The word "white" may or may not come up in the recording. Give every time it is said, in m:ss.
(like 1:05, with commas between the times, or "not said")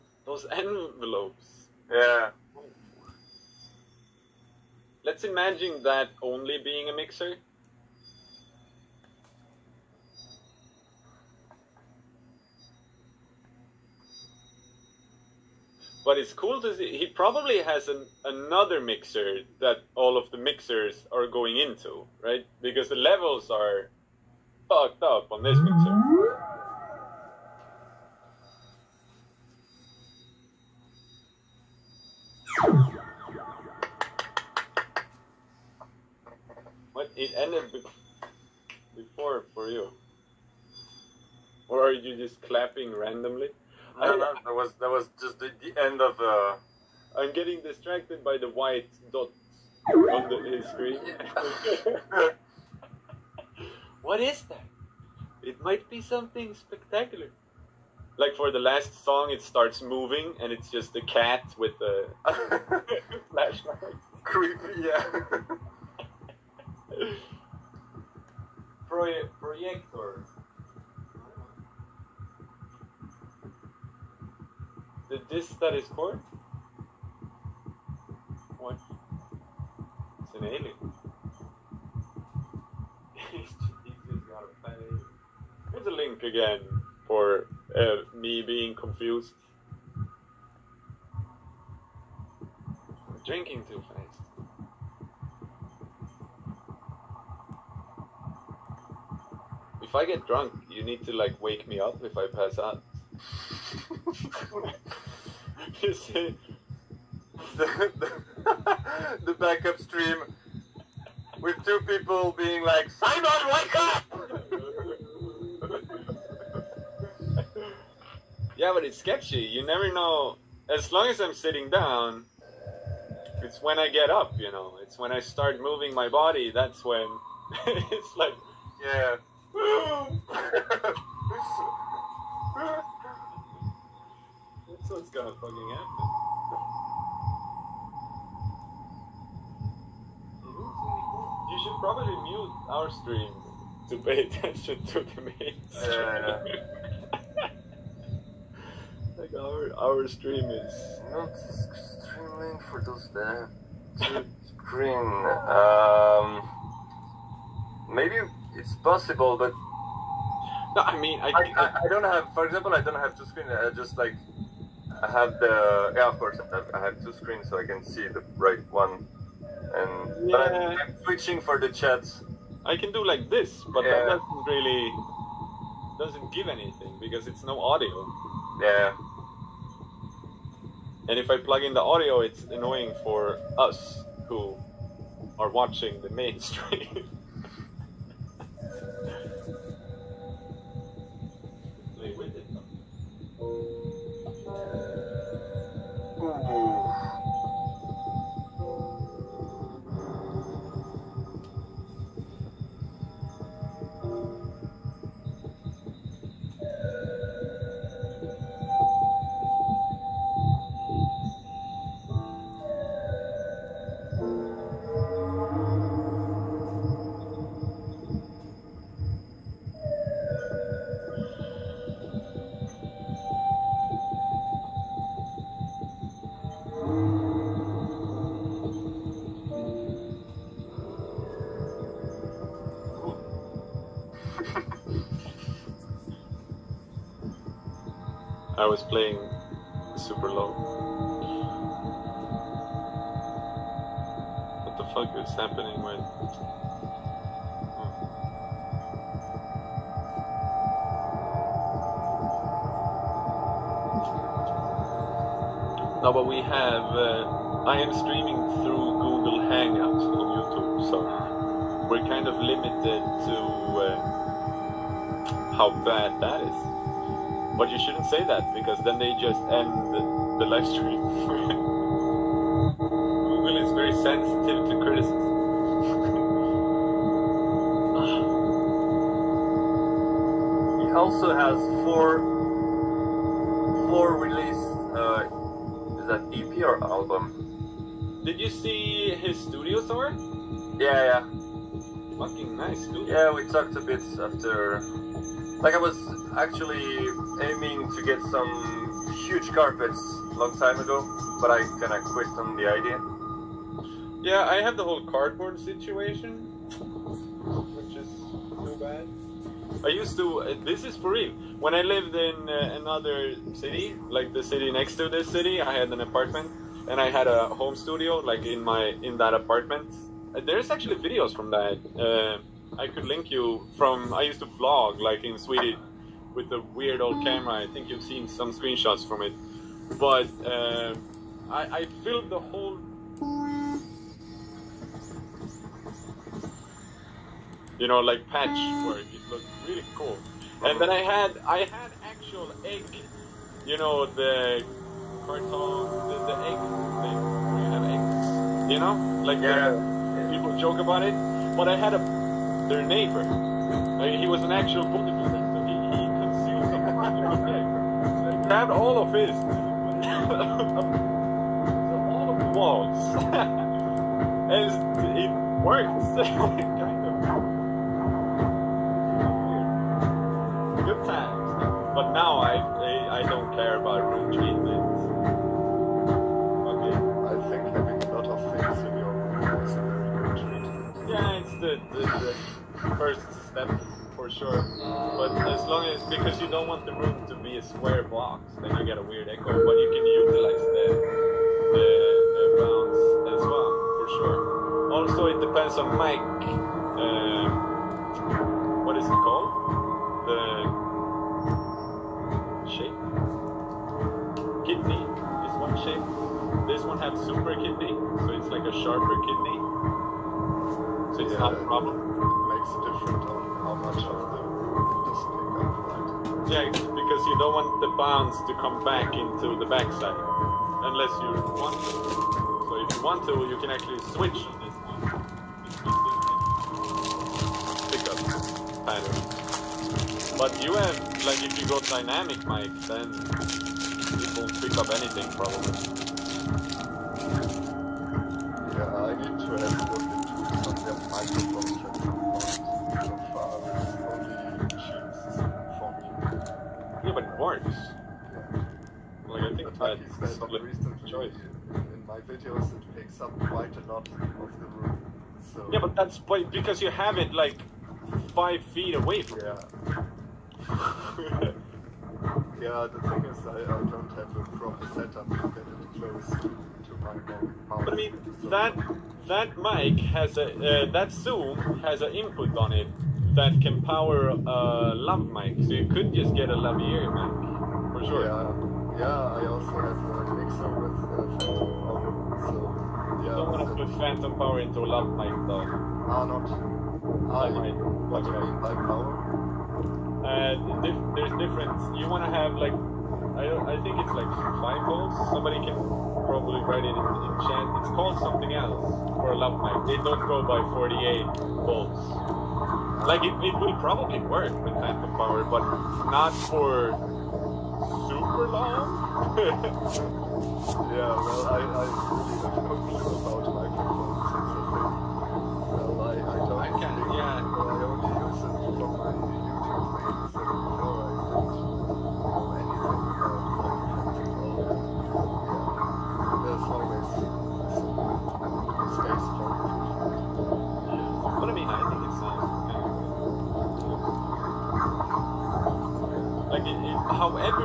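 0:48.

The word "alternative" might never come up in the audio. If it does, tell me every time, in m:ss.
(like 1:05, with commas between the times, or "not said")
not said.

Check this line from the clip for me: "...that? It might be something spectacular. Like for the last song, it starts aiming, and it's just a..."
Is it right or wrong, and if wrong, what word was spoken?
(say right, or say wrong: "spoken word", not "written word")
wrong: "moving", not "aiming".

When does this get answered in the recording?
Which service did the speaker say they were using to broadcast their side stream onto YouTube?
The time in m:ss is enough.
4:19.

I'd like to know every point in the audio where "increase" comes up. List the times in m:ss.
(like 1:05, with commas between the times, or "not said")
not said.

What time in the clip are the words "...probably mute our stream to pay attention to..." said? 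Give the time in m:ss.
2:21.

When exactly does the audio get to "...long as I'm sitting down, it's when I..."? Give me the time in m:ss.
2:00.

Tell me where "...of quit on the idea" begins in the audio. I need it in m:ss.
5:01.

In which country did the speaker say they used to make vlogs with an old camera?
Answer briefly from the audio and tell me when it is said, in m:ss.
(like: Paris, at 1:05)
Sweden, at 5:25.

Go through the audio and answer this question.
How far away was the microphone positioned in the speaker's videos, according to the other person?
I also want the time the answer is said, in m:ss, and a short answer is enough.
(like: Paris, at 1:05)
5 feet, at 7:38.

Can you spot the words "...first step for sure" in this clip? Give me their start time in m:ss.
6:22.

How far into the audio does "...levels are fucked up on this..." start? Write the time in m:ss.
0:22.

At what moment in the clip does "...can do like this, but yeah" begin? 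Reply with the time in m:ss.
2:52.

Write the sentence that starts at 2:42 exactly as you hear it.
For example, I don't have two screens.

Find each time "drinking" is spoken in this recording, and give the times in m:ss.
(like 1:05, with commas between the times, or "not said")
1:33.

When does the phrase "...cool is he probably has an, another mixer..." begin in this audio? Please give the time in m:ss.
0:16.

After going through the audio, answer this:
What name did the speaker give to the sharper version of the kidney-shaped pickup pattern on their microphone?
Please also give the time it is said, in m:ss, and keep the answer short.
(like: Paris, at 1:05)
Super kidney, at 6:47.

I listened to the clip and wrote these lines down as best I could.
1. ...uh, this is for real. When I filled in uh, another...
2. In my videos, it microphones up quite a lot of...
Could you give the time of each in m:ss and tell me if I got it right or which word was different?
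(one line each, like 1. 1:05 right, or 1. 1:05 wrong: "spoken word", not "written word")
1. 5:10 wrong: "lived", not "filled"
2. 7:31 wrong: "takes", not "microphones".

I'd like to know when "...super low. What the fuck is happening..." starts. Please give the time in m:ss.
3:59.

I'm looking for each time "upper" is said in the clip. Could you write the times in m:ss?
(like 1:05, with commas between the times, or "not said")
not said.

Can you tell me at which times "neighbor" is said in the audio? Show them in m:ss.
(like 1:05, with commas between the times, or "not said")
5:52.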